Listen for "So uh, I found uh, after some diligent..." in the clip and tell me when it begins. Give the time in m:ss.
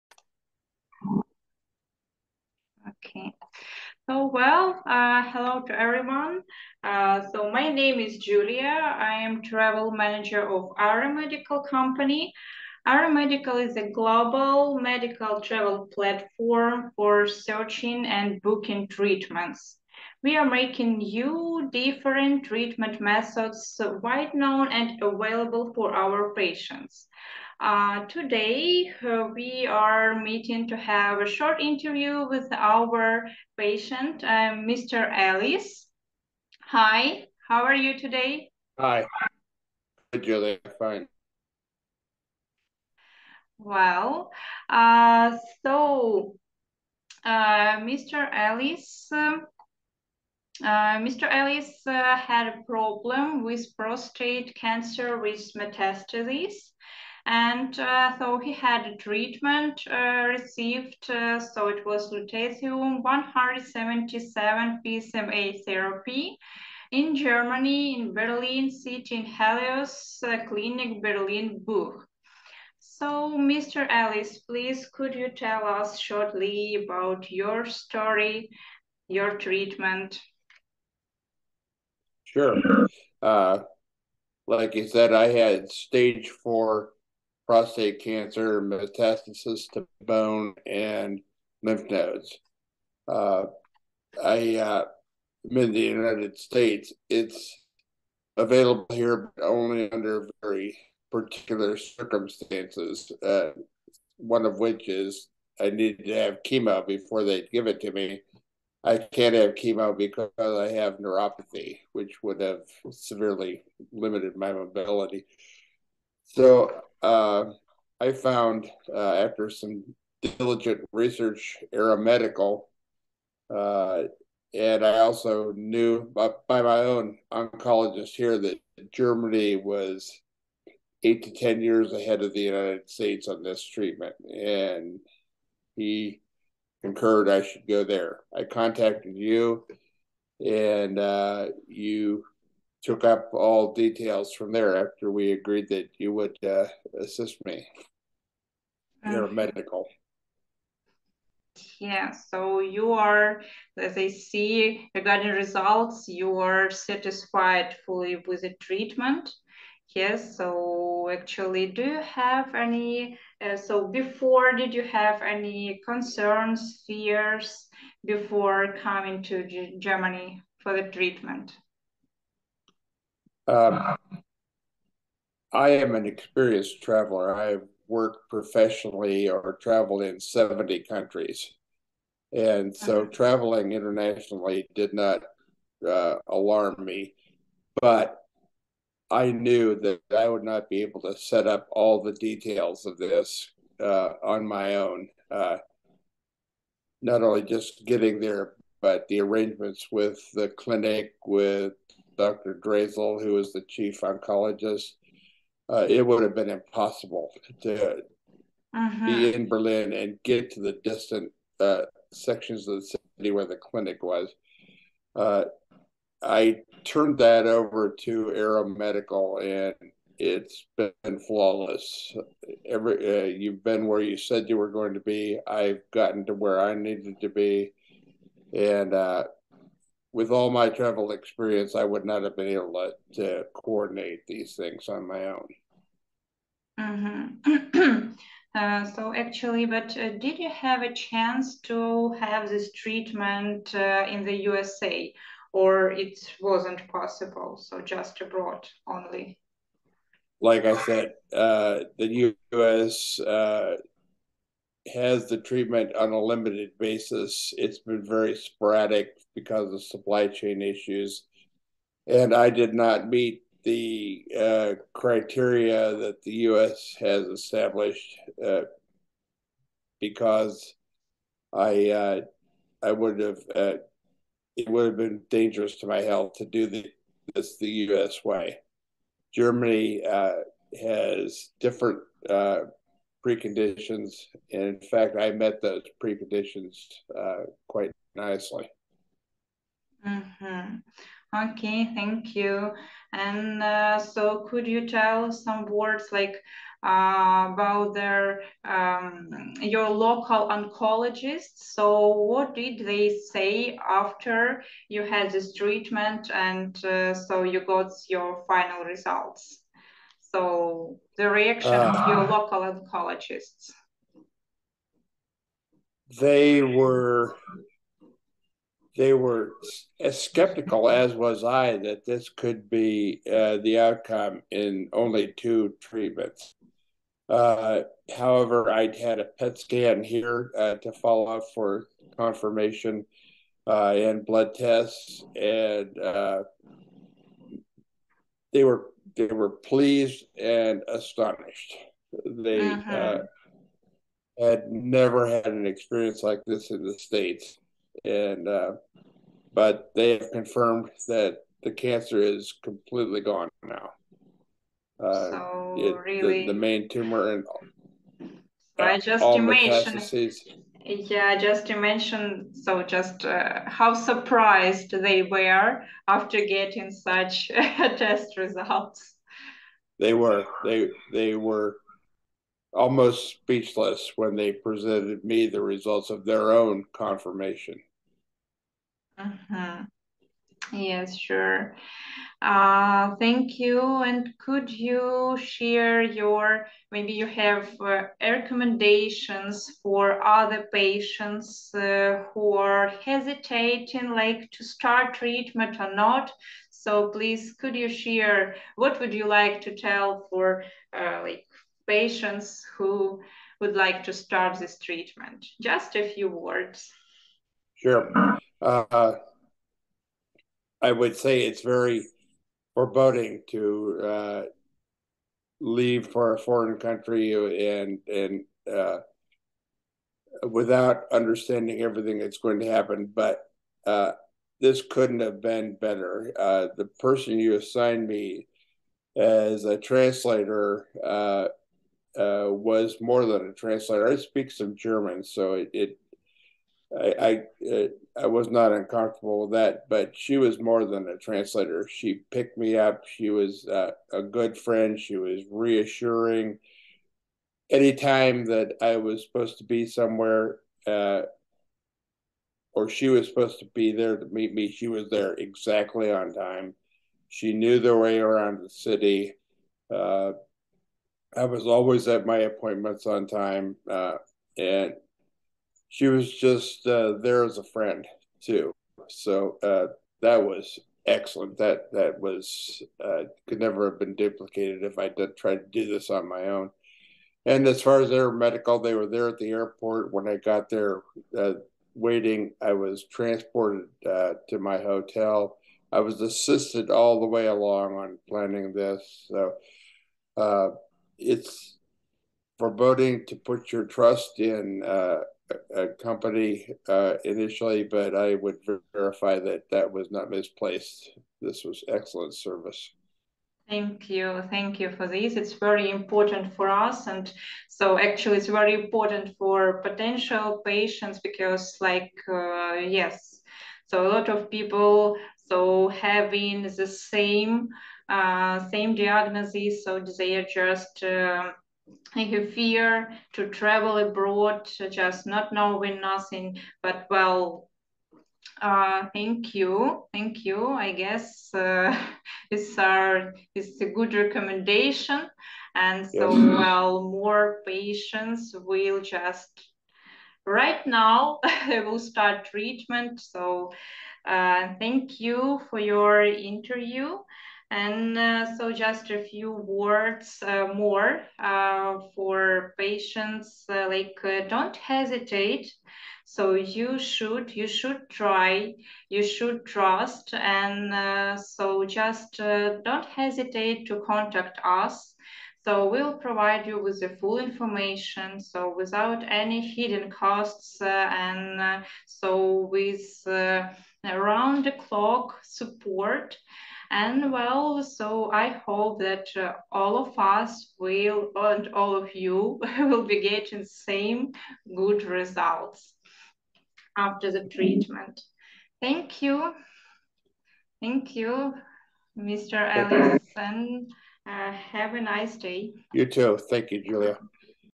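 1:56.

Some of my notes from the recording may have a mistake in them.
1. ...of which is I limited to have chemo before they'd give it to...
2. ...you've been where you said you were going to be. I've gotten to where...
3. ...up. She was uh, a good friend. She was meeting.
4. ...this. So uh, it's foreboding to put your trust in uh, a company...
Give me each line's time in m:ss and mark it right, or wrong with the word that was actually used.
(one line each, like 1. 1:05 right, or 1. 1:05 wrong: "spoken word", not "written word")
1. 1:44 wrong: "needed", not "limited"
2. 3:43 right
3. 7:22 wrong: "reassuring", not "meeting"
4. 8:08 right.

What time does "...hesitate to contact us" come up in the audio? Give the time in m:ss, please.
9:23.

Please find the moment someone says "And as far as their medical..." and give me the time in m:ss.
7:57.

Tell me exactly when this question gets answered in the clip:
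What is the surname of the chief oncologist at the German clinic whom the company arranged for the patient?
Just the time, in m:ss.
3:22.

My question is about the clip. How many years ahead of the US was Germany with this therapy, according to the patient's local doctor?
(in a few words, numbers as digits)
8 to 10 years.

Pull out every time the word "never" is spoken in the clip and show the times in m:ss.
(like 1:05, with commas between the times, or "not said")
5:44, 7:53.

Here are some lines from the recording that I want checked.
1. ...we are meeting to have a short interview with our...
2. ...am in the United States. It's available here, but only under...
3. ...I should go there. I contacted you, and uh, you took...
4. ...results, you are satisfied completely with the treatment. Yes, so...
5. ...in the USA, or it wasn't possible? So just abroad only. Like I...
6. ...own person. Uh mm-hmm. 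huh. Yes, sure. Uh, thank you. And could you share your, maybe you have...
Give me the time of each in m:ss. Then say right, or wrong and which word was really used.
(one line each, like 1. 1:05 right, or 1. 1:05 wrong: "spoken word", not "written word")
1. 0:29 right
2. 1:35 right
3. 2:17 right
4. 2:35 wrong: "fully", not "completely"
5. 4:04 right
6. 6:16 wrong: "confirmation", not "person".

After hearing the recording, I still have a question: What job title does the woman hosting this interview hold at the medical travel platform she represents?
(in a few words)
Travel manager.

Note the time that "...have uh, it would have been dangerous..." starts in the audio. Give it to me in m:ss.
4:33.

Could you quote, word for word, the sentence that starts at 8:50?
I guess uh, it's our it's a good recommendation, and so yes.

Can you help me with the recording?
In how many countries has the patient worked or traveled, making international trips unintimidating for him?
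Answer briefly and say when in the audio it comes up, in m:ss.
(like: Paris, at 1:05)
70, at 3:00.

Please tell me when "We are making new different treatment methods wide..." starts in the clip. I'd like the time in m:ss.
0:20.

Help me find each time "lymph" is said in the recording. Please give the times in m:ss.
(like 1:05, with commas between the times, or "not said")
1:31.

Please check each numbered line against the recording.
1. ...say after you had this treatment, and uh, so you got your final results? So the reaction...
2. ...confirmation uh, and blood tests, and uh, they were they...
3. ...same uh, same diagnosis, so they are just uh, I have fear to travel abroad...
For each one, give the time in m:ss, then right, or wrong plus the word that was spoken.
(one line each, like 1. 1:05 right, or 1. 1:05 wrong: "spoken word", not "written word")
1. 5:03 right
2. 5:32 right
3. 8:36 right.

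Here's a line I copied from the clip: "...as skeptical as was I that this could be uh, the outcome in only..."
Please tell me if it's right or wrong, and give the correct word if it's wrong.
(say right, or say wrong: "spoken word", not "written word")
right.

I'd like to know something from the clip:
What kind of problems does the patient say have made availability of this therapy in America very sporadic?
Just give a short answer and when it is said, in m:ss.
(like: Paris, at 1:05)
Supply chain issues, at 4:19.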